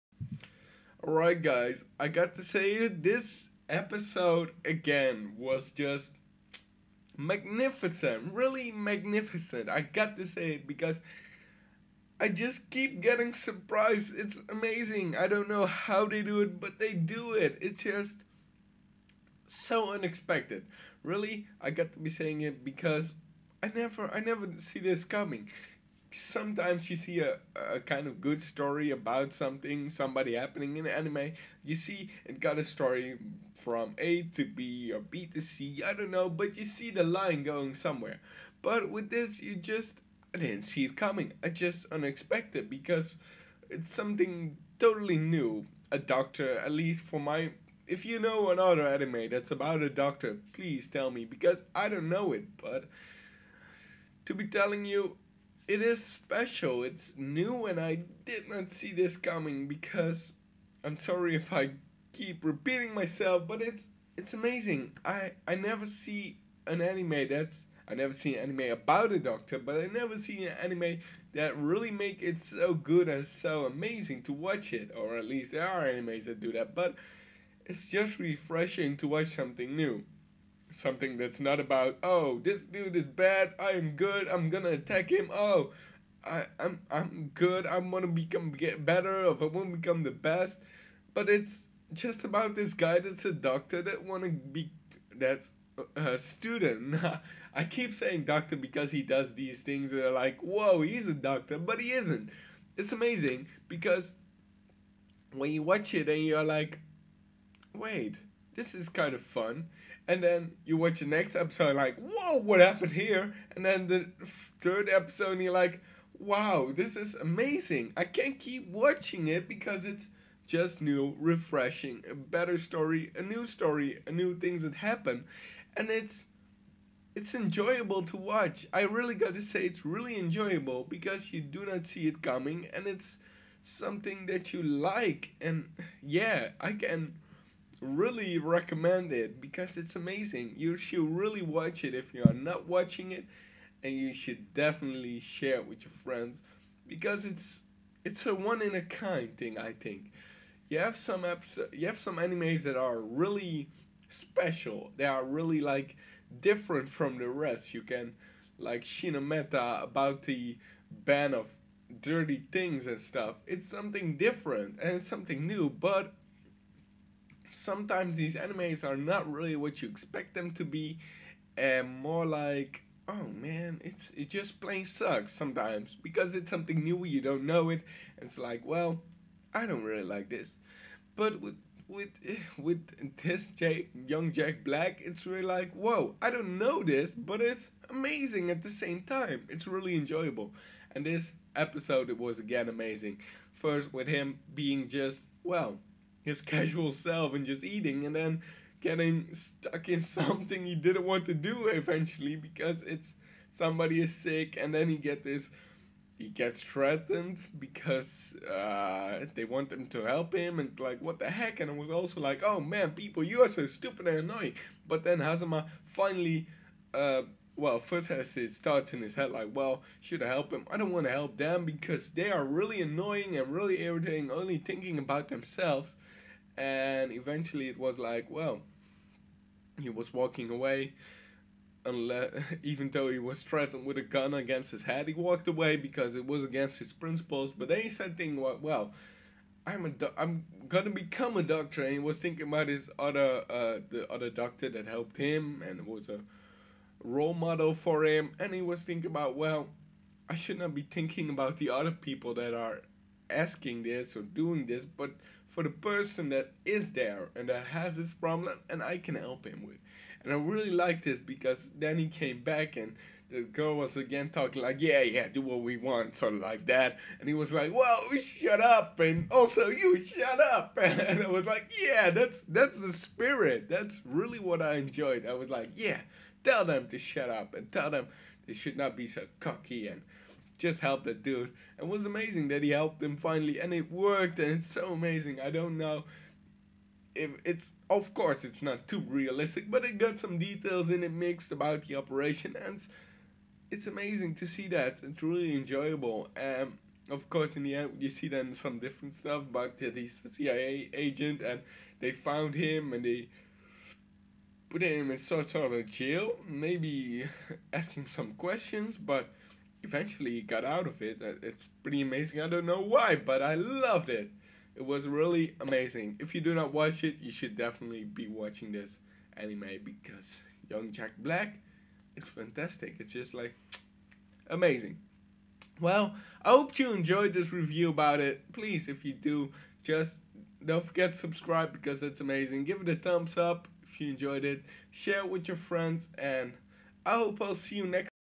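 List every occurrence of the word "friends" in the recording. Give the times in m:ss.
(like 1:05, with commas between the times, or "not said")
2:25, 5:35.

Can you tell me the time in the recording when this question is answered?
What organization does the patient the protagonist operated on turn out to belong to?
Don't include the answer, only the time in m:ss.
5:00.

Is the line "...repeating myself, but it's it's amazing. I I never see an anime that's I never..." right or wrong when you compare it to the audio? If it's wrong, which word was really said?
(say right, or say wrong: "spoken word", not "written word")
right.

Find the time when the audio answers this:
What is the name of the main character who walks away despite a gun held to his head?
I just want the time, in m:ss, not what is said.
3:35.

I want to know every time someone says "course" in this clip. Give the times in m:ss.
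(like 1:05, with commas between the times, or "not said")
4:48, 4:57.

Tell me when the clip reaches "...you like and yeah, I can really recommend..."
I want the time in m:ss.
2:14.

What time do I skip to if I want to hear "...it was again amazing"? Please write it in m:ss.
3:12.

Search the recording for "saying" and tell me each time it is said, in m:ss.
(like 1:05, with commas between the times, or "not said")
0:22, 1:37.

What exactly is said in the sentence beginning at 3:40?
I don't want to help them because they are really annoying and really irritating, only thinking about themselves.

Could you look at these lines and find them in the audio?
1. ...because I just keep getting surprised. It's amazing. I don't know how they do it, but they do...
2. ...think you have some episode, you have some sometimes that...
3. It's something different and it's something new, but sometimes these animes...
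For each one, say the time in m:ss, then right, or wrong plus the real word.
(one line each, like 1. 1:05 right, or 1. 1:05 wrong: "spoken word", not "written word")
1. 0:10 right
2. 2:29 wrong: "animes", not "sometimes"
3. 2:43 right.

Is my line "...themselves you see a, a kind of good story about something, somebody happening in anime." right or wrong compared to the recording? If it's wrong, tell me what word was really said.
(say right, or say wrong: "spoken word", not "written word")
wrong: "sometimes", not "themselves".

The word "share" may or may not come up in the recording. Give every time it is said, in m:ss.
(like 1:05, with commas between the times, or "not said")
2:25, 5:34.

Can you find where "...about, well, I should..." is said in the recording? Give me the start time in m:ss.
4:09.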